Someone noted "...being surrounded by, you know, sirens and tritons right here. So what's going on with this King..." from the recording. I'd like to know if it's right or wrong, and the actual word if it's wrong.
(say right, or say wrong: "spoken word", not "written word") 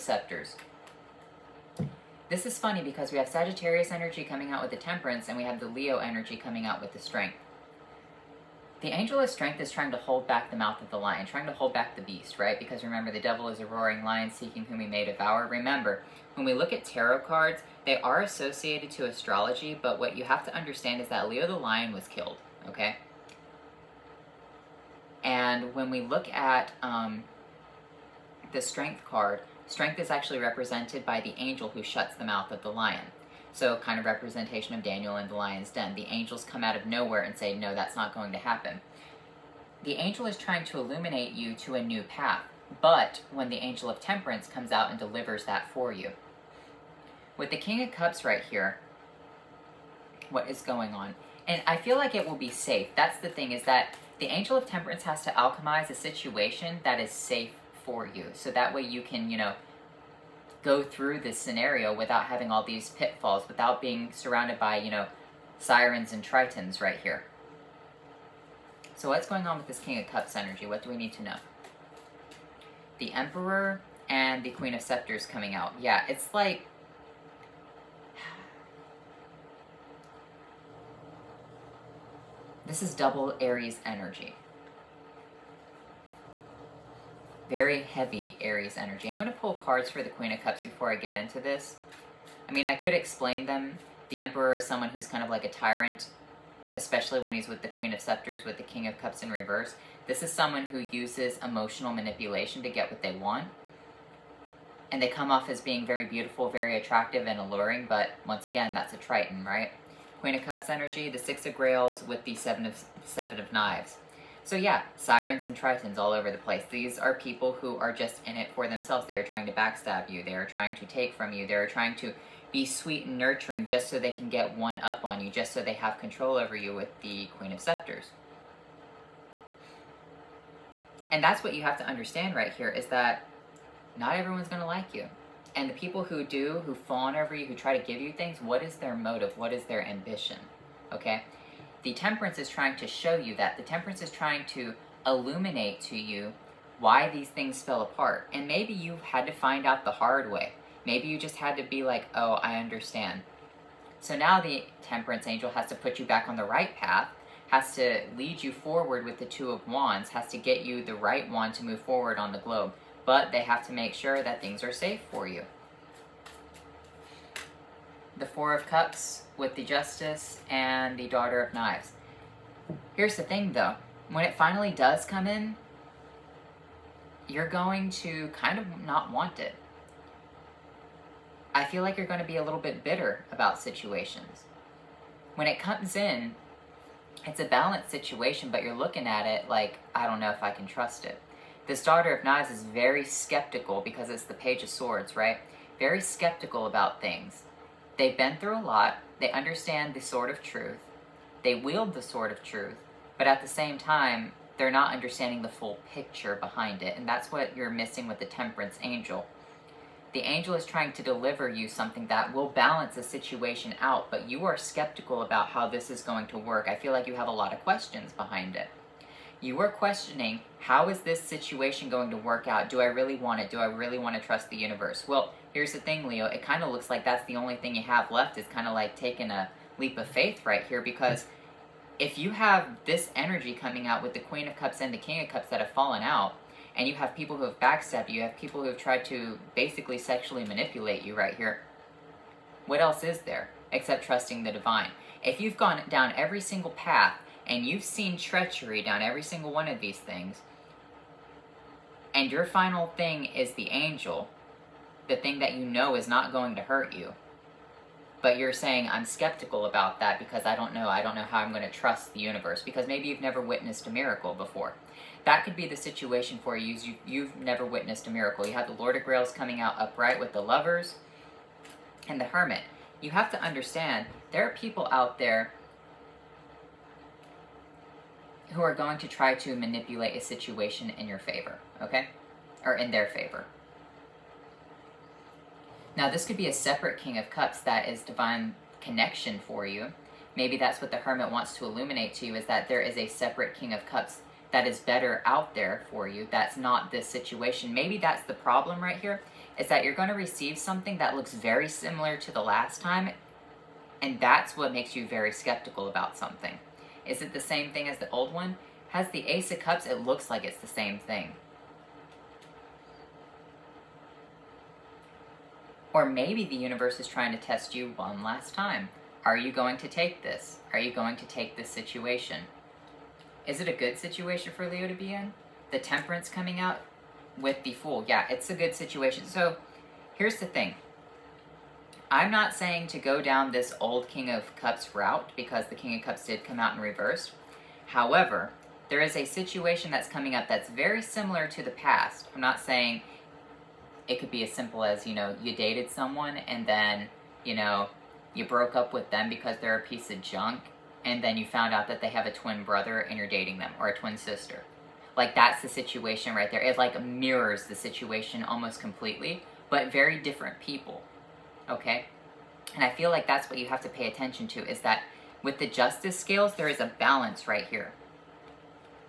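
right.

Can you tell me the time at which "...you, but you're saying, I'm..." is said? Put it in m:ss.
4:16.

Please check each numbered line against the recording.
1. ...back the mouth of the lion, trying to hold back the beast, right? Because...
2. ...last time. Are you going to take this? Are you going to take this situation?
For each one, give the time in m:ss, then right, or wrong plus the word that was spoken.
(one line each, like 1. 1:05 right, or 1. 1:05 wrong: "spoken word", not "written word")
1. 0:10 right
2. 5:18 right.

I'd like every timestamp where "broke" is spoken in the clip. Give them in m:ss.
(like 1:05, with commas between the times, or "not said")
5:48.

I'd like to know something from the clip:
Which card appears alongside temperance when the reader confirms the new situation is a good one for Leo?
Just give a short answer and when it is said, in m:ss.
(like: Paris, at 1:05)
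The Fool, at 5:27.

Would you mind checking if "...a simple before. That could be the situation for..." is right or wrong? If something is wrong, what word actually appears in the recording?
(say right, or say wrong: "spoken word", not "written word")
wrong: "miracle", not "simple".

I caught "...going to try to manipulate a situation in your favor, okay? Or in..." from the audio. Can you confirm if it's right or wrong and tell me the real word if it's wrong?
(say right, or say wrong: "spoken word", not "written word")
right.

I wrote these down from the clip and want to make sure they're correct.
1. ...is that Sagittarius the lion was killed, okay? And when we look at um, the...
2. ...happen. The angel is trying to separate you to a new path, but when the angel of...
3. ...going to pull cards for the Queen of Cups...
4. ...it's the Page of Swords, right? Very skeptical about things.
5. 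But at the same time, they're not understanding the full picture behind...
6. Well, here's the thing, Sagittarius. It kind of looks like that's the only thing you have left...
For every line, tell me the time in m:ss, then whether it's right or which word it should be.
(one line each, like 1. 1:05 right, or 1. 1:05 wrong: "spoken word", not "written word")
1. 0:21 wrong: "Leo", not "Sagittarius"
2. 0:38 wrong: "illuminate", not "separate"
3. 1:29 right
4. 3:14 right
5. 3:23 right
6. 3:45 wrong: "Leo", not "Sagittarius".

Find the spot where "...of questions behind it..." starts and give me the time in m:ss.
3:37.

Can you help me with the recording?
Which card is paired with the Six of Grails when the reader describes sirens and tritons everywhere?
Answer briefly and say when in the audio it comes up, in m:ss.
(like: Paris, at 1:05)
Seven of Knives, at 1:53.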